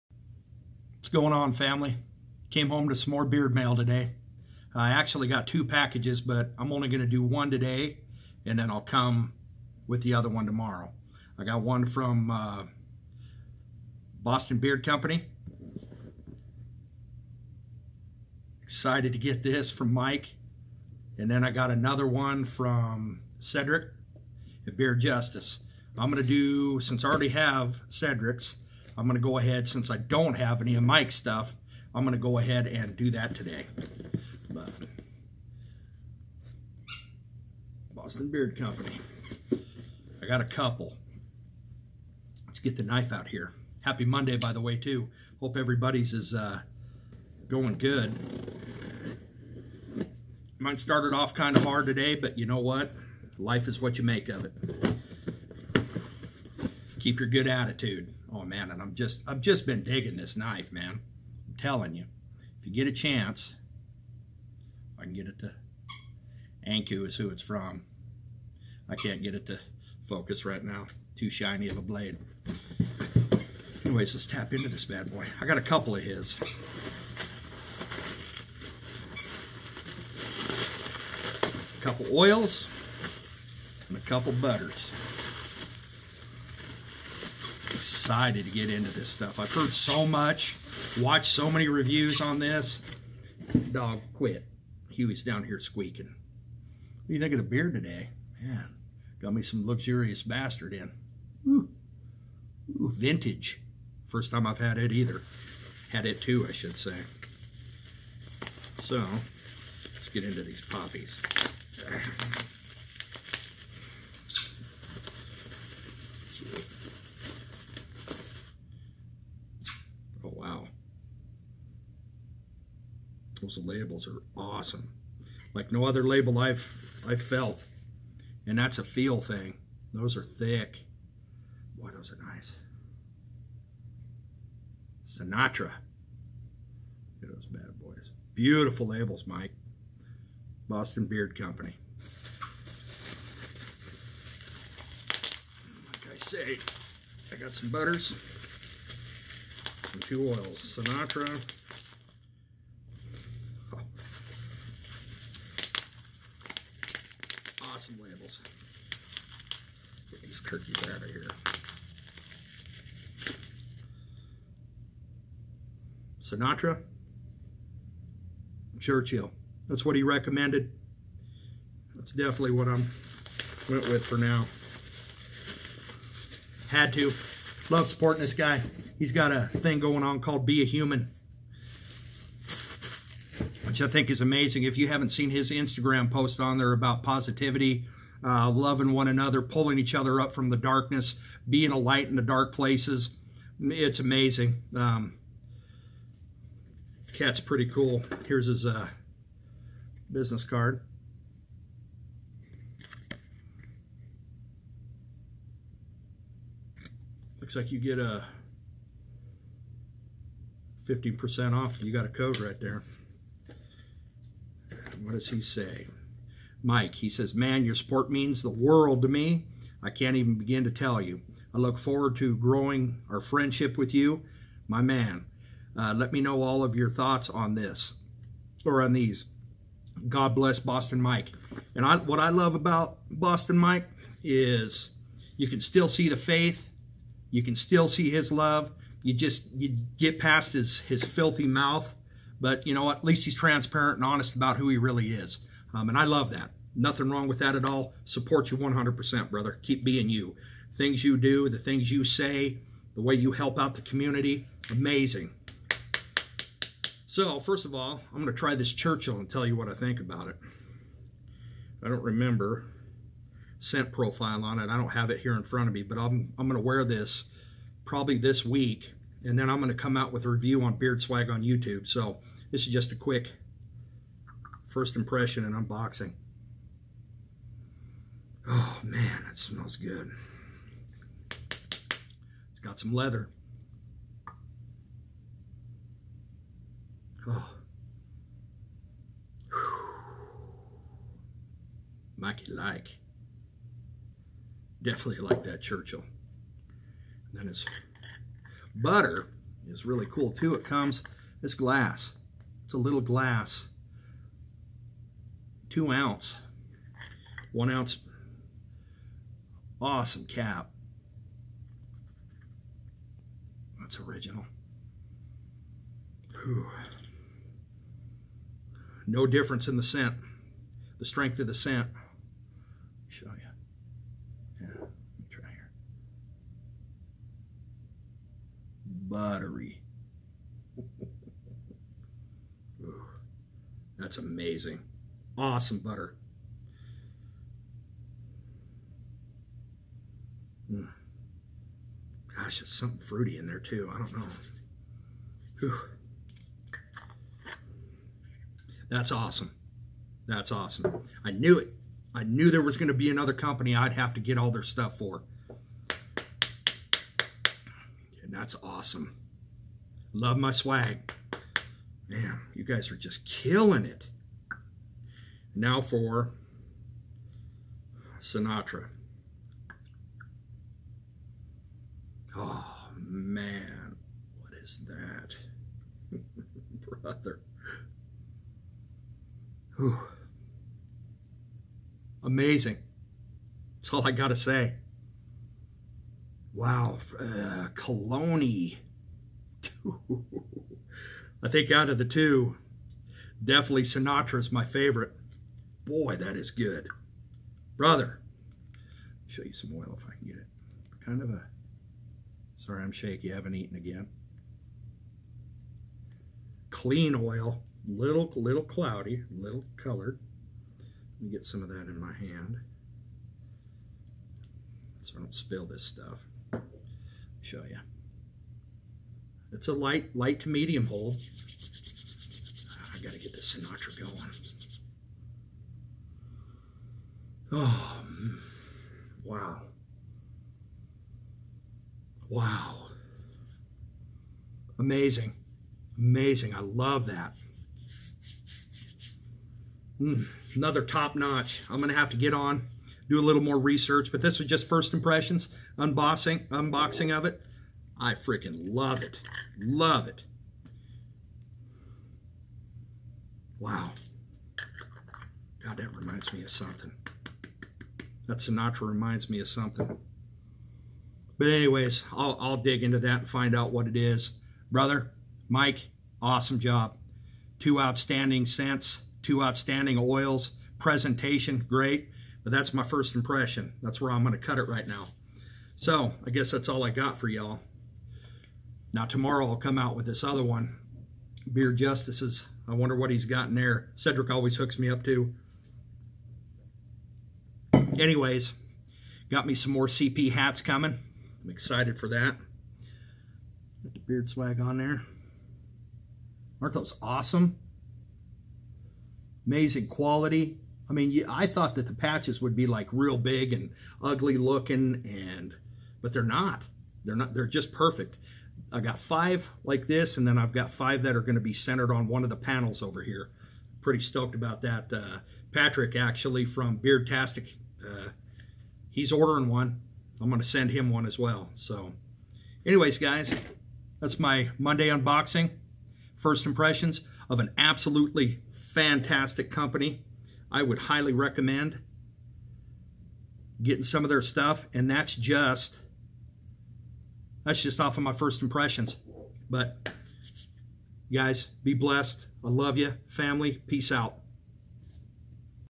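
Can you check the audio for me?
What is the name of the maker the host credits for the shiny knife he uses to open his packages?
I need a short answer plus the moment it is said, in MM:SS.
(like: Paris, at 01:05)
Anku, at 01:06.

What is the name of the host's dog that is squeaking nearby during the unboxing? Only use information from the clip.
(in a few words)
Huey.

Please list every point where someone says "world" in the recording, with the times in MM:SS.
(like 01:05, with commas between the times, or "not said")
03:38.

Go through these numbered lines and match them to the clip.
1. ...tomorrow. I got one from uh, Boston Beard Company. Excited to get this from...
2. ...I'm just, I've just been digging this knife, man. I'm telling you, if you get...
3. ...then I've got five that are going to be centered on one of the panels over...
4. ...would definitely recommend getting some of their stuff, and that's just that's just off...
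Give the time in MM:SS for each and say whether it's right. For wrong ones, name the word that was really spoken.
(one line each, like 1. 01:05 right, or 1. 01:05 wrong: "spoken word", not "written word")
1. 00:10 right
2. 00:58 right
3. 08:30 right
4. 08:50 wrong: "highly", not "definitely".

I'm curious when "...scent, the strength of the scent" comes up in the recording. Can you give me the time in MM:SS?
05:19.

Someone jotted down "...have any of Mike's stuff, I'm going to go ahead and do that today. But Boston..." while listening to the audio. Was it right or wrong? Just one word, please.
right.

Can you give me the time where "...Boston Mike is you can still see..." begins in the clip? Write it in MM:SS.
03:53.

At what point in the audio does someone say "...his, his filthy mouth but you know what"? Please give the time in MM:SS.
04:00.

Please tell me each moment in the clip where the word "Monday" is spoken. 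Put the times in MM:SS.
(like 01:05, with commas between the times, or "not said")
00:44, 08:44.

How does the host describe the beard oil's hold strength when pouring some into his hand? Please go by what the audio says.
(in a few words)
light to medium.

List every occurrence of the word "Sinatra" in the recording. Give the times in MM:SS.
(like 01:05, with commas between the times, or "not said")
02:15, 02:30, 02:46, 06:08, 06:33, 07:03, 07:38.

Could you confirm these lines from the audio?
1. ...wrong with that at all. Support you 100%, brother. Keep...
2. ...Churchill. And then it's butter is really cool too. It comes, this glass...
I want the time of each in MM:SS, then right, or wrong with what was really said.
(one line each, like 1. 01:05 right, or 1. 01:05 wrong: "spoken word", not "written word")
1. 04:07 right
2. 04:55 right.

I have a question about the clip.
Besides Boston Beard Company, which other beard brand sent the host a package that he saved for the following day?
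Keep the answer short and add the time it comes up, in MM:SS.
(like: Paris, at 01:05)
Beard Justice, at 00:24.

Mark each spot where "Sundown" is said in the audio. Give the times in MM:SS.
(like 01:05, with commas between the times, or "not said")
not said.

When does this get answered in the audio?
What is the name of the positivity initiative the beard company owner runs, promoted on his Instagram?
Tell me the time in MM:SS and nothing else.
03:00.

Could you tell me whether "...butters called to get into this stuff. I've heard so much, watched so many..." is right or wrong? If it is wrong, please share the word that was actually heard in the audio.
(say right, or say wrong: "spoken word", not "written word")
wrong: "excited", not "called".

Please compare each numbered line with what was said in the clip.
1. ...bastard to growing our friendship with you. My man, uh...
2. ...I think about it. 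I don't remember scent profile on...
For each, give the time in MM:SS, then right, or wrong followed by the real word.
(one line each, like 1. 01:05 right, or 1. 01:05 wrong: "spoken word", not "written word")
1. 03:41 wrong: "forward", not "bastard"
2. 04:19 right.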